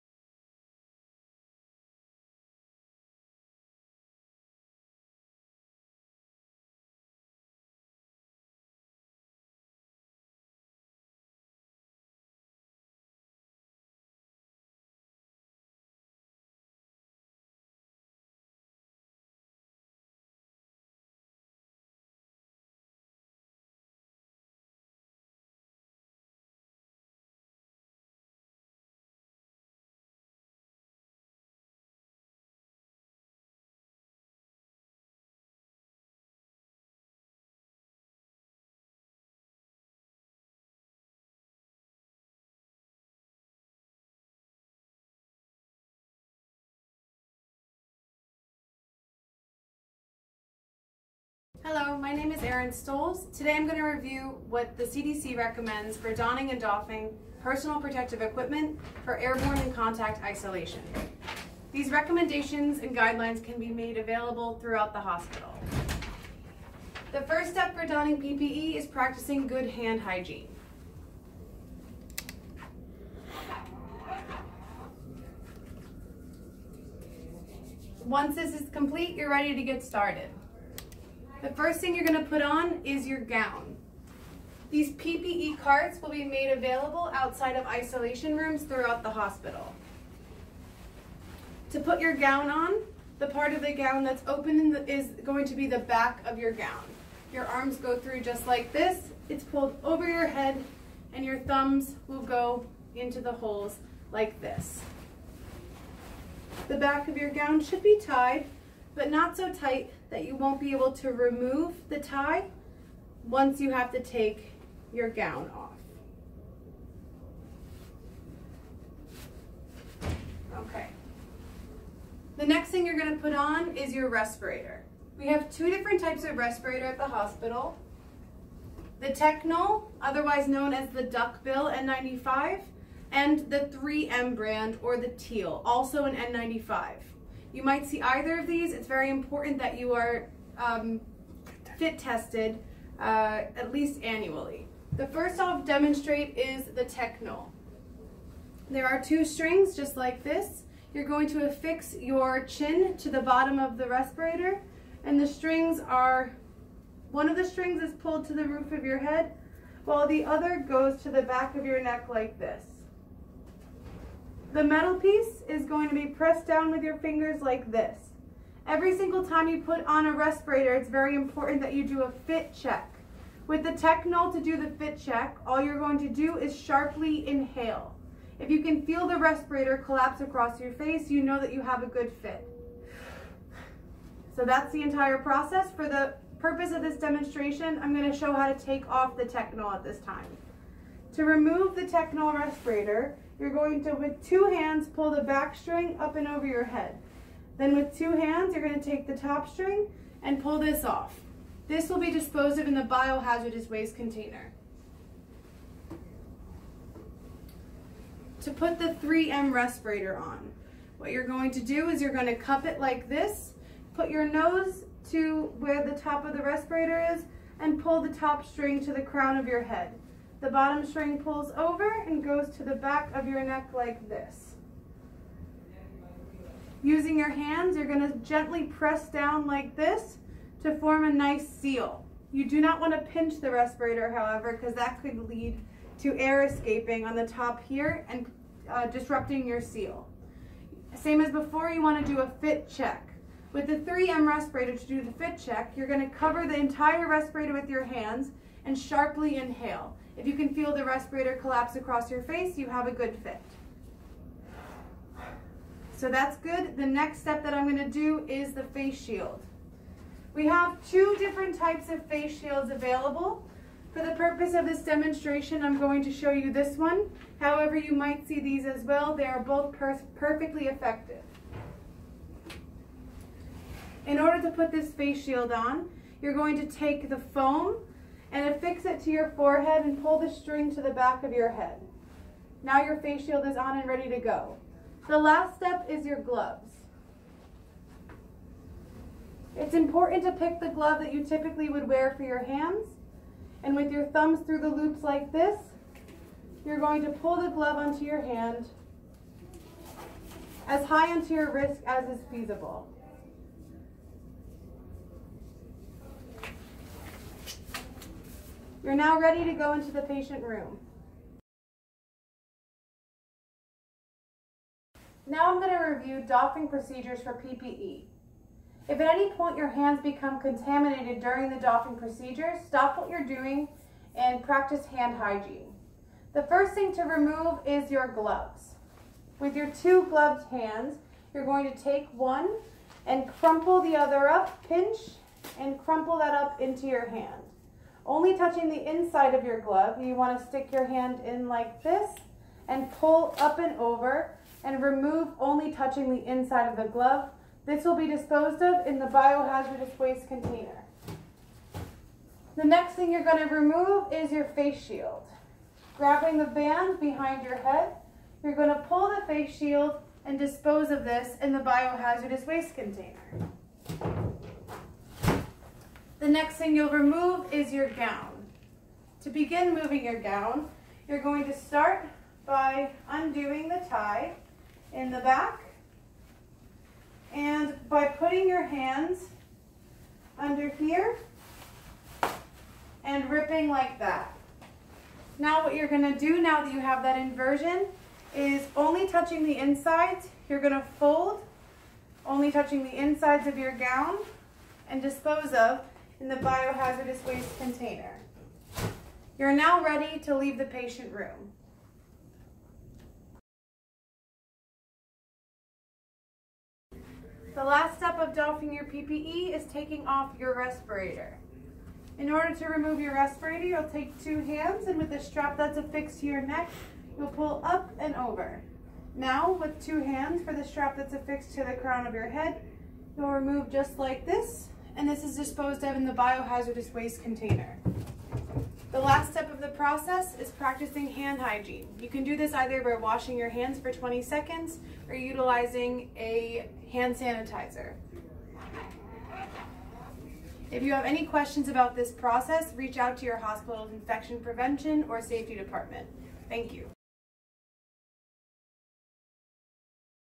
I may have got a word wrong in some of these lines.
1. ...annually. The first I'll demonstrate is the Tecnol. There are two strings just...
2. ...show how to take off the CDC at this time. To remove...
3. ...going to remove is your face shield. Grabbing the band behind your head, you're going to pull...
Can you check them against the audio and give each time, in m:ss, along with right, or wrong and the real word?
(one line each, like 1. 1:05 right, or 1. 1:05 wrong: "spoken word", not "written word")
1. 2:24 right
2. 3:08 wrong: "Tecnol", not "CDC"
3. 5:53 right.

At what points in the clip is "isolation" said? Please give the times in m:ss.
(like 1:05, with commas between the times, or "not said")
1:00, 1:27.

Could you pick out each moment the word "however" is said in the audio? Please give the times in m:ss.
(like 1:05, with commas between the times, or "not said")
3:54, 4:27.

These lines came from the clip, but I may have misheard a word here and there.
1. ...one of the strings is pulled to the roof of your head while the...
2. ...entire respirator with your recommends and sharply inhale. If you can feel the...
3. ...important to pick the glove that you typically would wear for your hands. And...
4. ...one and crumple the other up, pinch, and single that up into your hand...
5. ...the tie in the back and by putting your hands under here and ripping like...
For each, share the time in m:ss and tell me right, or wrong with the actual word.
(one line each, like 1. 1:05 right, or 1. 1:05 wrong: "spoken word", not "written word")
1. 2:37 right
2. 4:06 wrong: "hands", not "recommends"
3. 4:49 right
4. 5:32 wrong: "crumple", not "single"
5. 6:13 right.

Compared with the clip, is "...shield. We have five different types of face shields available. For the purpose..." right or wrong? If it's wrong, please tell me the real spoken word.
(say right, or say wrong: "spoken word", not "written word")
wrong: "two", not "five".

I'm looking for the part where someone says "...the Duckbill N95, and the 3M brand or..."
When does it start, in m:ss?
2:10.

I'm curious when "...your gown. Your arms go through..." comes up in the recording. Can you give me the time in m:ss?
1:36.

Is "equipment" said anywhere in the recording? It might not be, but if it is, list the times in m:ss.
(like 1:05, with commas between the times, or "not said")
0:58.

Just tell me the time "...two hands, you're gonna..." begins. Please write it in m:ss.
3:17.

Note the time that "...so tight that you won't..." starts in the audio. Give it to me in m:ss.
1:49.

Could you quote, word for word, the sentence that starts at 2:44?
The metal piece is going to be pressed down with your fingers like this.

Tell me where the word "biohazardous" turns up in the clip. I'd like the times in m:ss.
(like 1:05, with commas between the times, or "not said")
3:22, 5:49, 6:01, 6:36, 7:06.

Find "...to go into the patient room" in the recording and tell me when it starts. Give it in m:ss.
5:09.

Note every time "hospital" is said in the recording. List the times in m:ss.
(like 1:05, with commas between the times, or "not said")
1:05, 1:29, 2:07, 7:23.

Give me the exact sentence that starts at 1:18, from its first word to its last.
Once this is complete, you're ready to get started.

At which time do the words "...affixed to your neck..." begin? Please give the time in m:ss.
6:55.